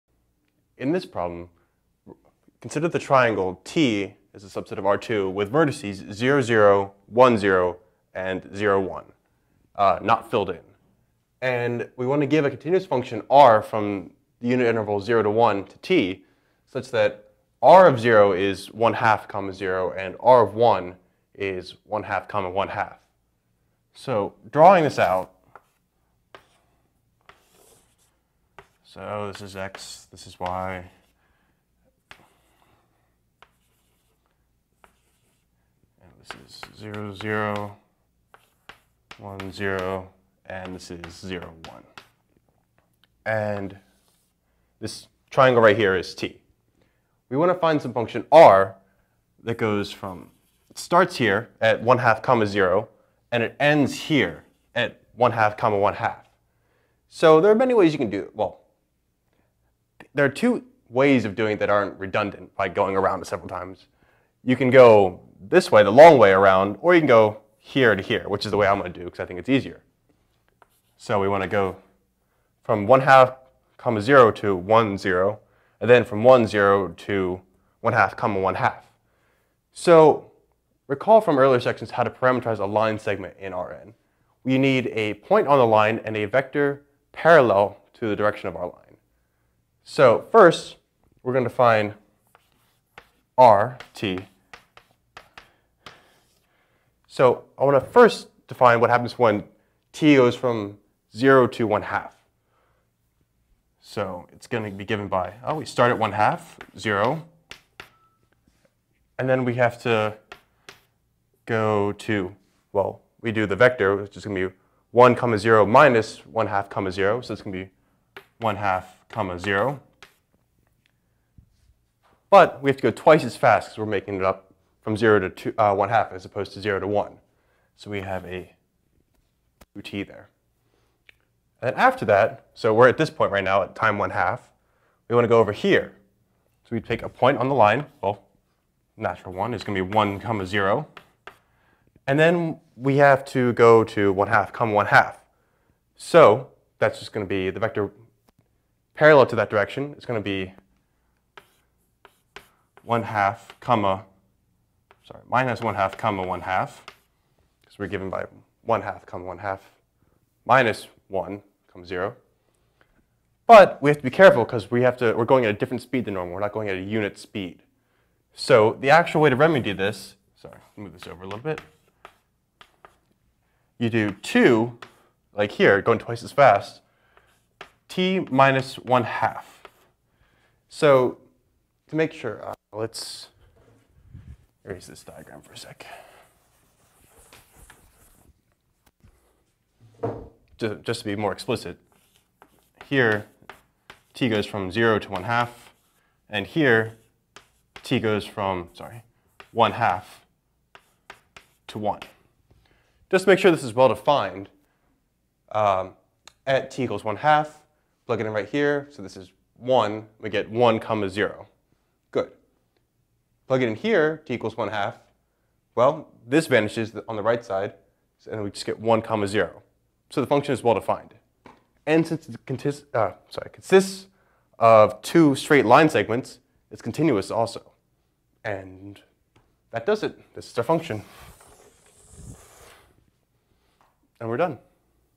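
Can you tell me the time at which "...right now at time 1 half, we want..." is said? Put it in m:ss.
2:13.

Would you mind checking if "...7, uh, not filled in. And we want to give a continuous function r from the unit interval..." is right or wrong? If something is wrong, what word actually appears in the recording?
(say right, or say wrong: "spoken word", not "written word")
wrong: "1", not "7".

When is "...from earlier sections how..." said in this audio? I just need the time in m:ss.
1:21.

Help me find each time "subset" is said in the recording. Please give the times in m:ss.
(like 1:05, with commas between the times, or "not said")
0:04.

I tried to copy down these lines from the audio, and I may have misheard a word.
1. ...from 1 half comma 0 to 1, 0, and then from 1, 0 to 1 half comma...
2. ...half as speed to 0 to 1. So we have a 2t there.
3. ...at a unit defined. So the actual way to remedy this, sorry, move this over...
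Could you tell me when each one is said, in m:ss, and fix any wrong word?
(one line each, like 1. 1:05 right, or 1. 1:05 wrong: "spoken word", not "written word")
1. 1:12 right
2. 2:05 wrong: "opposed", not "speed"
3. 2:46 wrong: "speed", not "defined".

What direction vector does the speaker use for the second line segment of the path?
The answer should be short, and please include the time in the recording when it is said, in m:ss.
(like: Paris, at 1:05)
(-1/2, 1/2), at 2:35.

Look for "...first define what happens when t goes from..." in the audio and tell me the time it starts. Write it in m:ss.
1:37.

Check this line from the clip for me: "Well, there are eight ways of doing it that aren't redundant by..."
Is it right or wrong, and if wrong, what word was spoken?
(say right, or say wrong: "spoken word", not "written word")
wrong: "two", not "eight".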